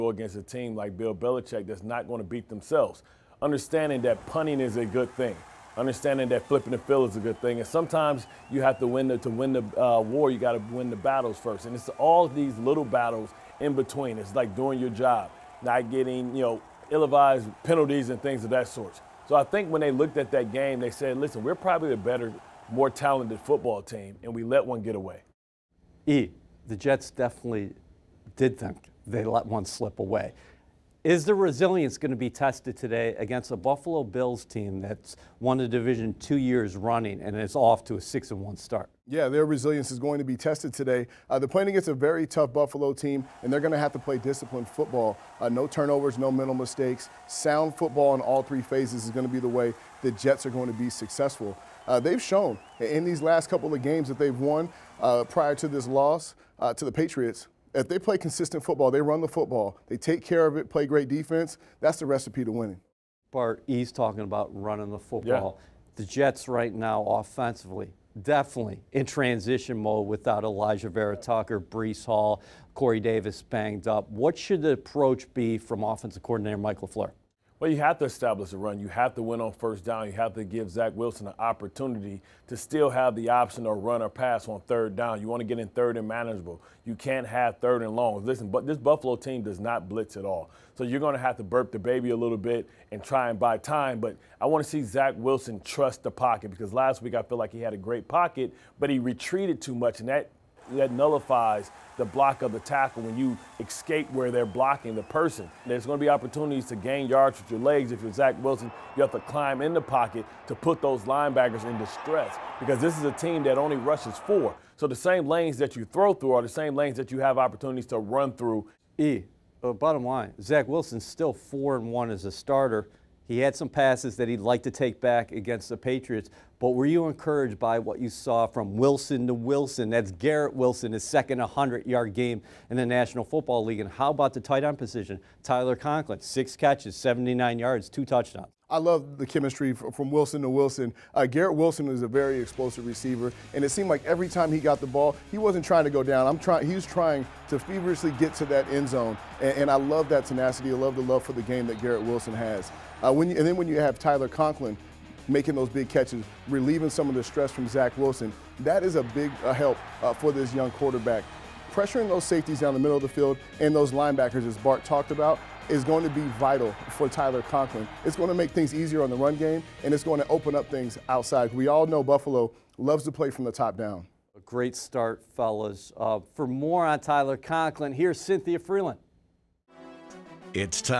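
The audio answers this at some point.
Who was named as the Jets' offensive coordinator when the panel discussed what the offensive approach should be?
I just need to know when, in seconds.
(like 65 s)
76 s.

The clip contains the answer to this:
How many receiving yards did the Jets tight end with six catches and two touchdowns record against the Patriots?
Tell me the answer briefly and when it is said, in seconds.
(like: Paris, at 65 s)
79, at 136 s.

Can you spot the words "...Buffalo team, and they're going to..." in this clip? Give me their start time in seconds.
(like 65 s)
42 s.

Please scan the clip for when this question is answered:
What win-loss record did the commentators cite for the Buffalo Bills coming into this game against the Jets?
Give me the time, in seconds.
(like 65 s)
38 s.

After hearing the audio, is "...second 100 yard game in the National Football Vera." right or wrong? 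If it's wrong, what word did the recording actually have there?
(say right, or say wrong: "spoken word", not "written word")
wrong: "League", not "Vera".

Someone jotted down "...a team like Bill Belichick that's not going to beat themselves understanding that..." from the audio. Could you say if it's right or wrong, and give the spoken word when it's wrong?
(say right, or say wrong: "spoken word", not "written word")
right.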